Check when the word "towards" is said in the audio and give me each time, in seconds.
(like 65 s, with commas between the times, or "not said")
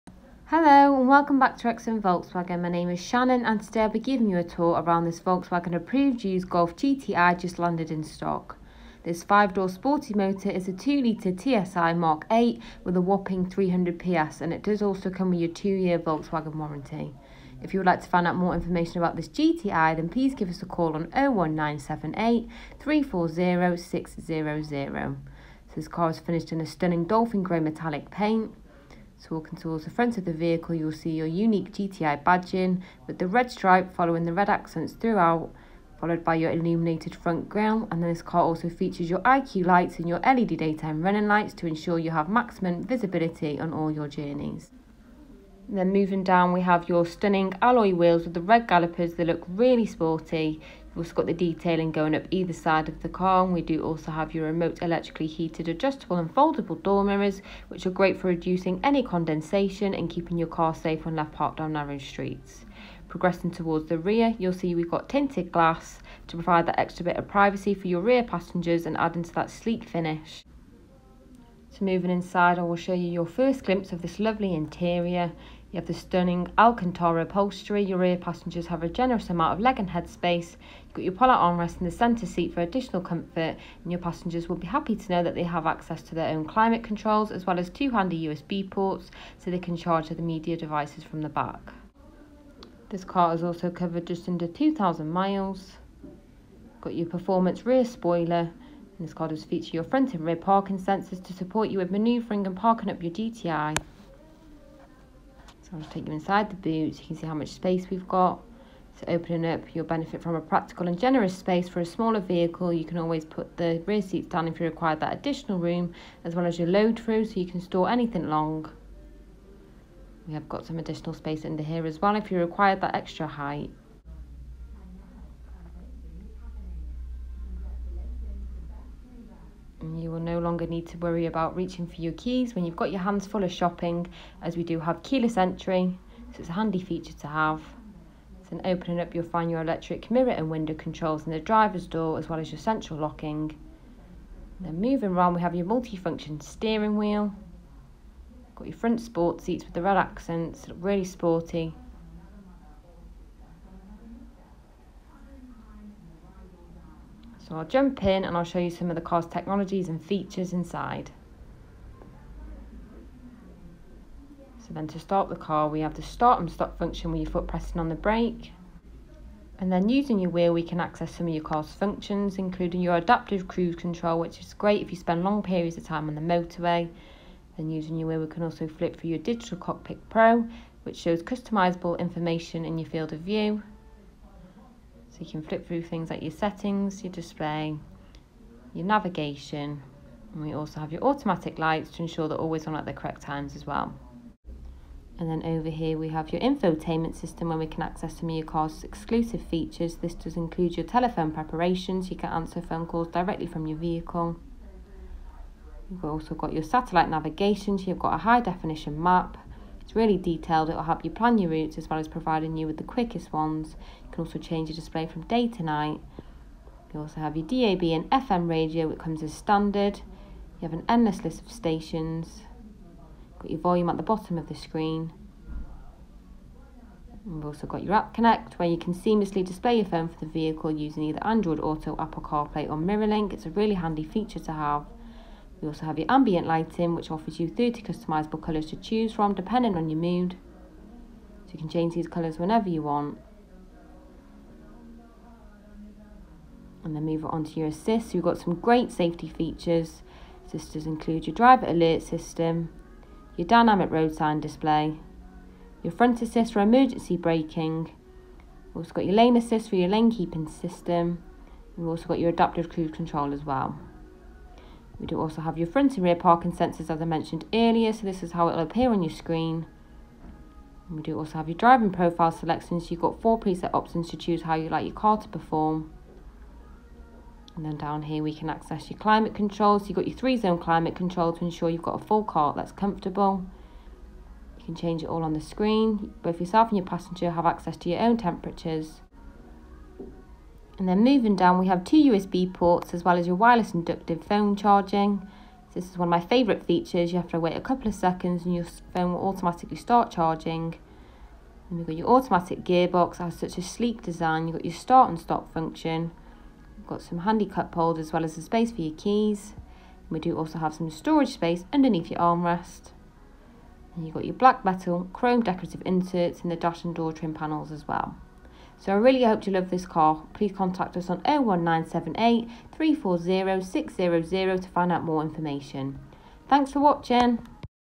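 29 s, 63 s.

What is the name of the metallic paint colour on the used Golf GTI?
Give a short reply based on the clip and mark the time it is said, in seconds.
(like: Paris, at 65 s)
Dolphin grey, at 27 s.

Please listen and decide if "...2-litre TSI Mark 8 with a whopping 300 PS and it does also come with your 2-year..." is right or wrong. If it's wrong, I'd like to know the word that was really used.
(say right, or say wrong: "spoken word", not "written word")
right.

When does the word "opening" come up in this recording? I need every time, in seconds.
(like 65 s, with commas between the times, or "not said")
109 s, 138 s.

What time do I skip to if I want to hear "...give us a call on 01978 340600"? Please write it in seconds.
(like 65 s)
20 s.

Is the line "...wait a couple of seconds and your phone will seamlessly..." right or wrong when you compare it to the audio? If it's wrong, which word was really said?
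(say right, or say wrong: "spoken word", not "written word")
wrong: "automatically", not "seamlessly".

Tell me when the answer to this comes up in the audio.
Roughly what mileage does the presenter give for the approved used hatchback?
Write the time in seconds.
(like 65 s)
94 s.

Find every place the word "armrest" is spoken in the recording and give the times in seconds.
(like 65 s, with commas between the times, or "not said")
81 s, 312 s.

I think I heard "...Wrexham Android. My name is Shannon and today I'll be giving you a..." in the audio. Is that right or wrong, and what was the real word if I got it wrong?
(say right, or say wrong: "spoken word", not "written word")
wrong: "Volkswagen", not "Android".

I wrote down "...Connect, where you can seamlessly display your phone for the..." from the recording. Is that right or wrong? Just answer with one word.
right.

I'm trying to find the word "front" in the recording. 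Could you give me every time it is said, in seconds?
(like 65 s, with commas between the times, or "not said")
29 s, 37 s, 99 s, 148 s, 255 s, 265 s.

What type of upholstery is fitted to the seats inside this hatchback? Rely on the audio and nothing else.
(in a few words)
Alcantara.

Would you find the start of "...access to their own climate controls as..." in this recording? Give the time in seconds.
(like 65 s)
85 s.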